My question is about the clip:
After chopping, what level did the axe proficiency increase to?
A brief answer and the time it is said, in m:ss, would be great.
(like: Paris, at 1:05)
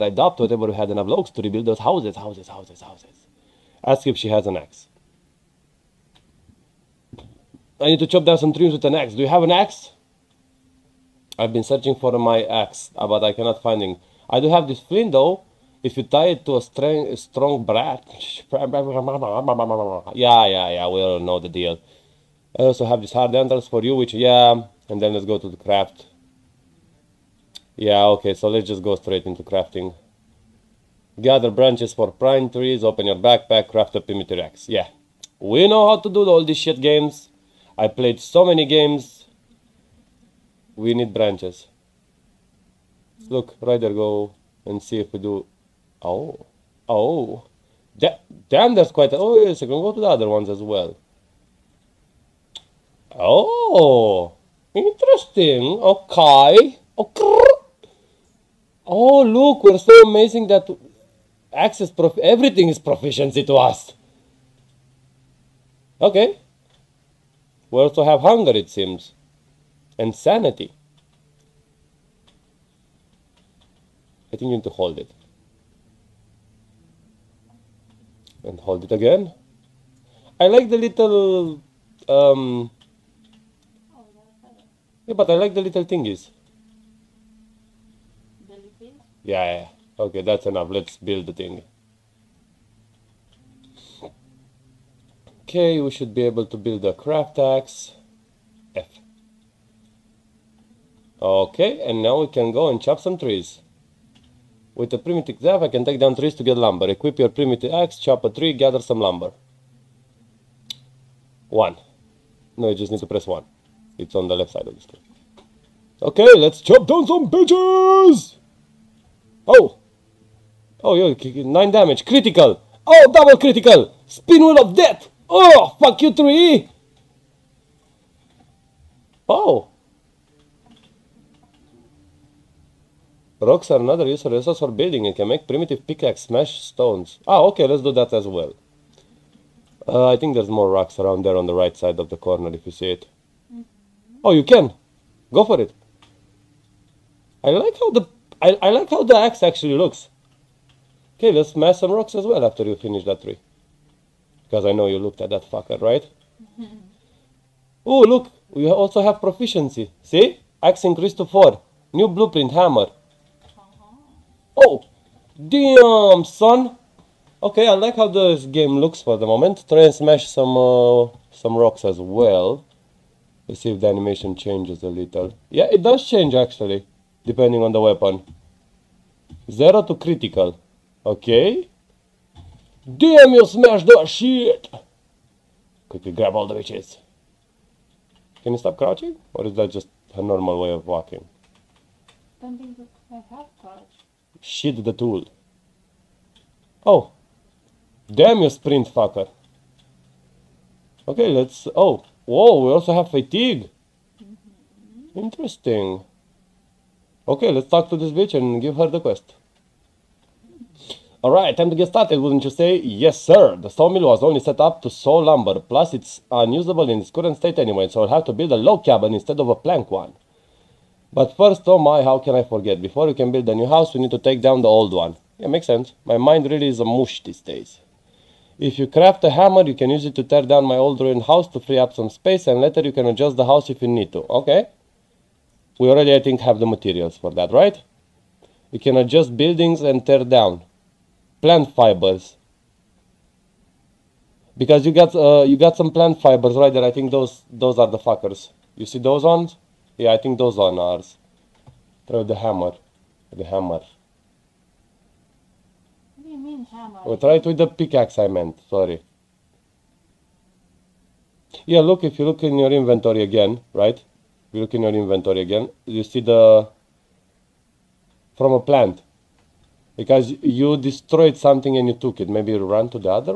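4, at 2:40.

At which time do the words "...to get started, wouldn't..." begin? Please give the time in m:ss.
3:31.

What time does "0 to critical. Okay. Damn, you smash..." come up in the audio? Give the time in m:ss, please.
2:59.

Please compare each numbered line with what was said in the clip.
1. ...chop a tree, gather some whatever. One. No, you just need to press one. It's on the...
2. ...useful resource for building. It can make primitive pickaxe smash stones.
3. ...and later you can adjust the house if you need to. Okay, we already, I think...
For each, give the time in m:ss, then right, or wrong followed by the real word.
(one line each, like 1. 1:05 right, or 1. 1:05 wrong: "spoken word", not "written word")
1. 1:47 wrong: "lumber", not "whatever"
2. 2:14 right
3. 3:52 right.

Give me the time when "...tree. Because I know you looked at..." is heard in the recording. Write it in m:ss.
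2:33.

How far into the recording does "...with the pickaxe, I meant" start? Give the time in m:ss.
4:17.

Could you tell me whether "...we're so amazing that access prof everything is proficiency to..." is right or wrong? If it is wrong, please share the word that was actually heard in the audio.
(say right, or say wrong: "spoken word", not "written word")
right.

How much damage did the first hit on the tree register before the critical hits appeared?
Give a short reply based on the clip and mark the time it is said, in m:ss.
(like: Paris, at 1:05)
9, at 2:01.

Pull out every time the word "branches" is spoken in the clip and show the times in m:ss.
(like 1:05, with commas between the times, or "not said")
0:31, 0:41.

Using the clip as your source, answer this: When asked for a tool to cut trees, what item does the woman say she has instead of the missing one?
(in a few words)
flint.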